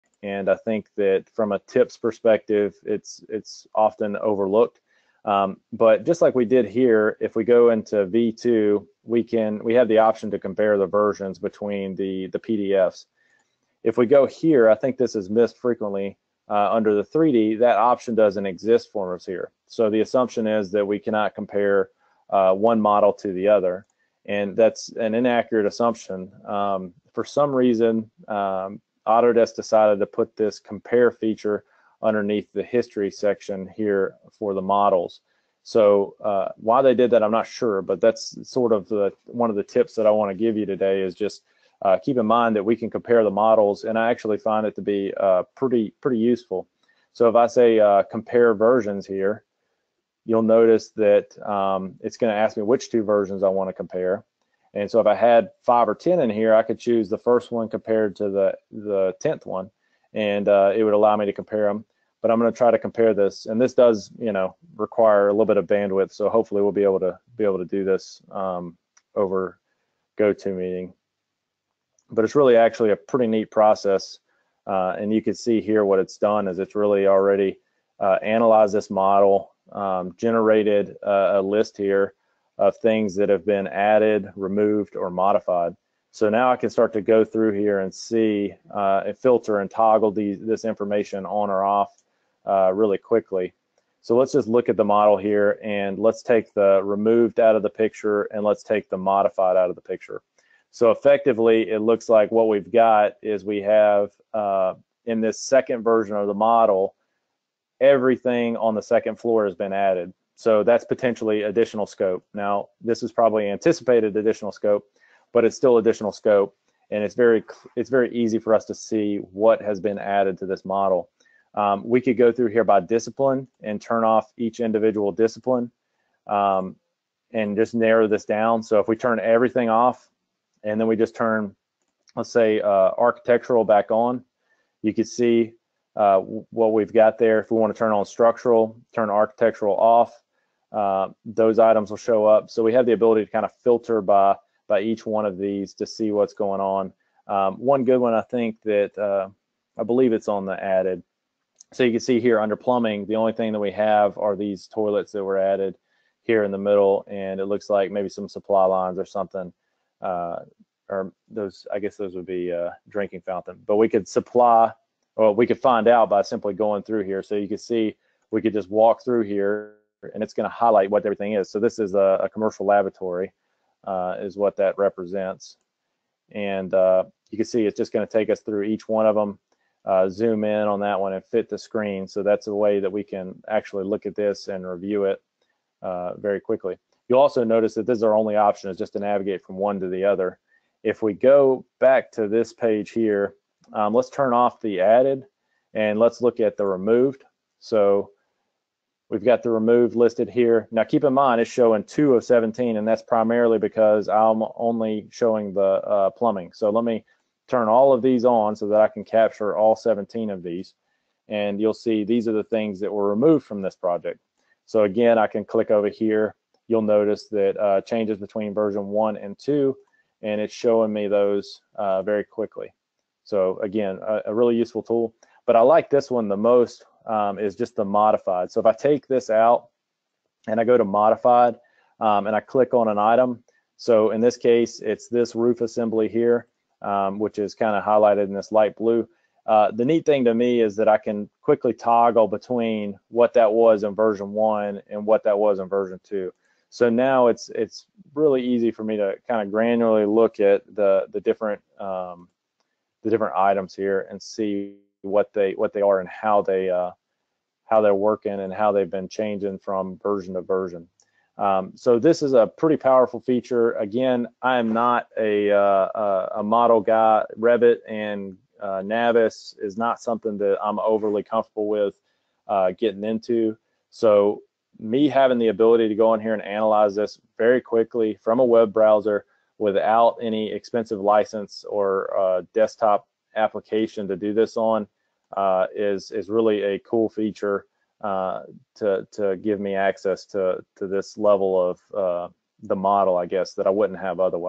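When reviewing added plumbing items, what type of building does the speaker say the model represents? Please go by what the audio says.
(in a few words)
Commercial laboratory.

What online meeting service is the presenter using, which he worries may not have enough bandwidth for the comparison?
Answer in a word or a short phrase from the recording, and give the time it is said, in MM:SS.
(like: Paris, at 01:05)
GoToMeeting, at 01:10.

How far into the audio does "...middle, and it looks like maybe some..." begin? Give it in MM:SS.
02:36.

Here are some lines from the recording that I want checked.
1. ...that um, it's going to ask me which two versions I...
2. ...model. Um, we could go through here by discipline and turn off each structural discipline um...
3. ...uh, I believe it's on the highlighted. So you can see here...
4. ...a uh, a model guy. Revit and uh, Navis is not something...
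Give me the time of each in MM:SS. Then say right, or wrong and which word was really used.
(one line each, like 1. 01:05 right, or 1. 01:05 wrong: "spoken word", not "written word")
1. 00:50 right
2. 02:00 wrong: "individual", not "structural"
3. 02:28 wrong: "added", not "highlighted"
4. 04:25 right.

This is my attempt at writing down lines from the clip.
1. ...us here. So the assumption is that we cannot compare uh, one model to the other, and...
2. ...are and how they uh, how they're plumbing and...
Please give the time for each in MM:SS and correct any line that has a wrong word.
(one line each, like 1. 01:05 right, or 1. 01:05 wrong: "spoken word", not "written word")
1. 00:19 right
2. 04:15 wrong: "working", not "plumbing".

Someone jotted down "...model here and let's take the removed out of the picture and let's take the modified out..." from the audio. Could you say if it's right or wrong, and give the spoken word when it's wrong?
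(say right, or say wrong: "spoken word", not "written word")
right.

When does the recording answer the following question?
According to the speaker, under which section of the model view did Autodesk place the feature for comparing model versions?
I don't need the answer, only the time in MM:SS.
00:32.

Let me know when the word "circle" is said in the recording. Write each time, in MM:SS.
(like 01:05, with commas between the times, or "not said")
not said.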